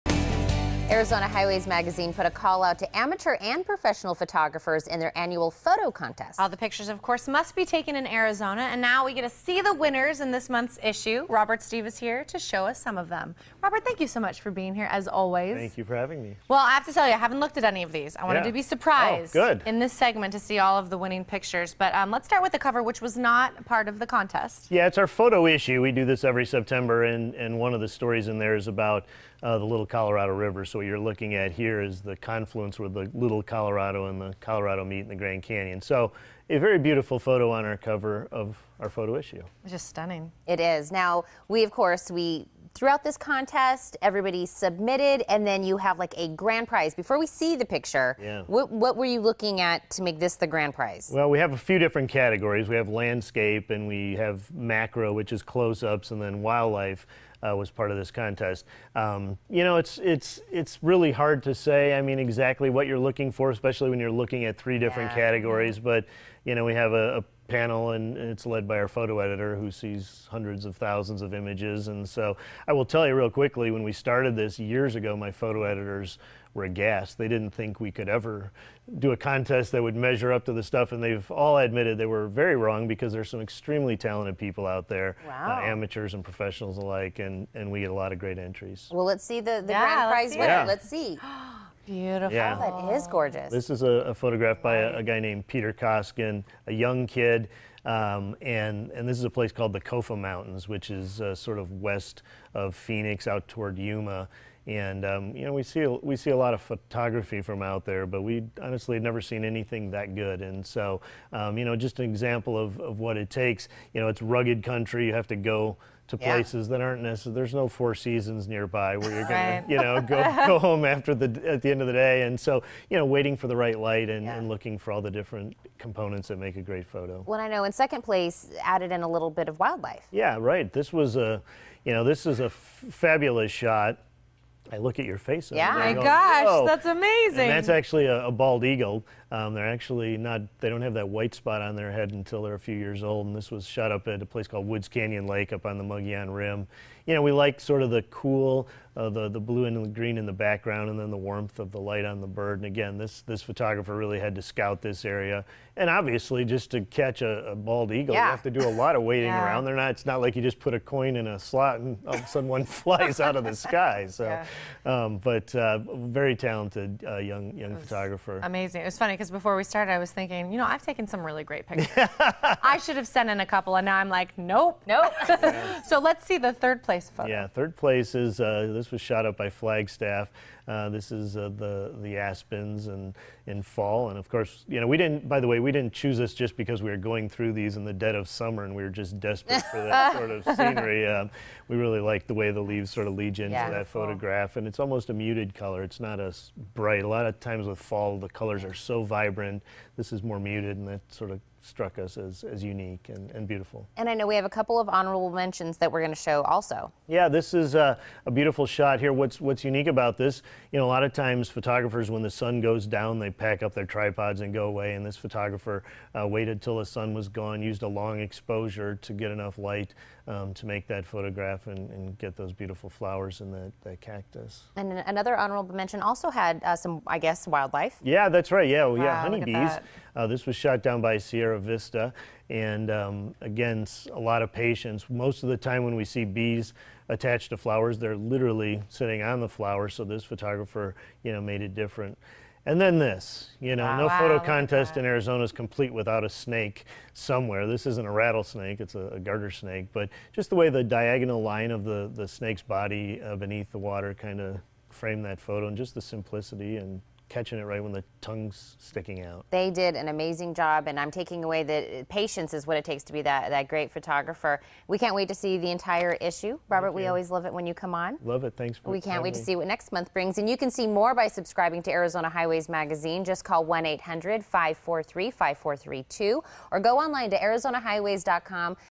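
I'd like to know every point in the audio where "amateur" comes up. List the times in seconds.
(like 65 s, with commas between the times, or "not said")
2 s, 85 s.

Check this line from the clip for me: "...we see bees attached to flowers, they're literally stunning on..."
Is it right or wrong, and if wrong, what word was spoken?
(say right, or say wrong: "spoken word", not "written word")
wrong: "sitting", not "stunning".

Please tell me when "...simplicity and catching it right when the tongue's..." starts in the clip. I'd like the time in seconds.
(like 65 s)
256 s.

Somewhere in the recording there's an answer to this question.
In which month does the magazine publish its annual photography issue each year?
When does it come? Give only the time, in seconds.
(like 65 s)
26 s.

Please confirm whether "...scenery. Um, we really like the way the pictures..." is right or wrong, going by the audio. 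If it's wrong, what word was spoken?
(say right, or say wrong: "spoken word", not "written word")
wrong: "leaves", not "pictures".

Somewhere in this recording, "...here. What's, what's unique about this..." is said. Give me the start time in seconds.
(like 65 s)
208 s.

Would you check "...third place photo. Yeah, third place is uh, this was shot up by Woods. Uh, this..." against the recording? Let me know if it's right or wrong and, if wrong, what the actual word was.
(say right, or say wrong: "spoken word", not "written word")
wrong: "Flagstaff", not "Woods".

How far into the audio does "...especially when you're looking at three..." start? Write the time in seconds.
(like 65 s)
63 s.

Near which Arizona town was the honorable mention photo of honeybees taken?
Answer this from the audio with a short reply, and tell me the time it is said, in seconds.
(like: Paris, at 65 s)
Sierra Vista, at 231 s.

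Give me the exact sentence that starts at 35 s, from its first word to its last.
So a very beautiful photo on our cover of our photo issue.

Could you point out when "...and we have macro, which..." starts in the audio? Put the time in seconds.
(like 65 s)
53 s.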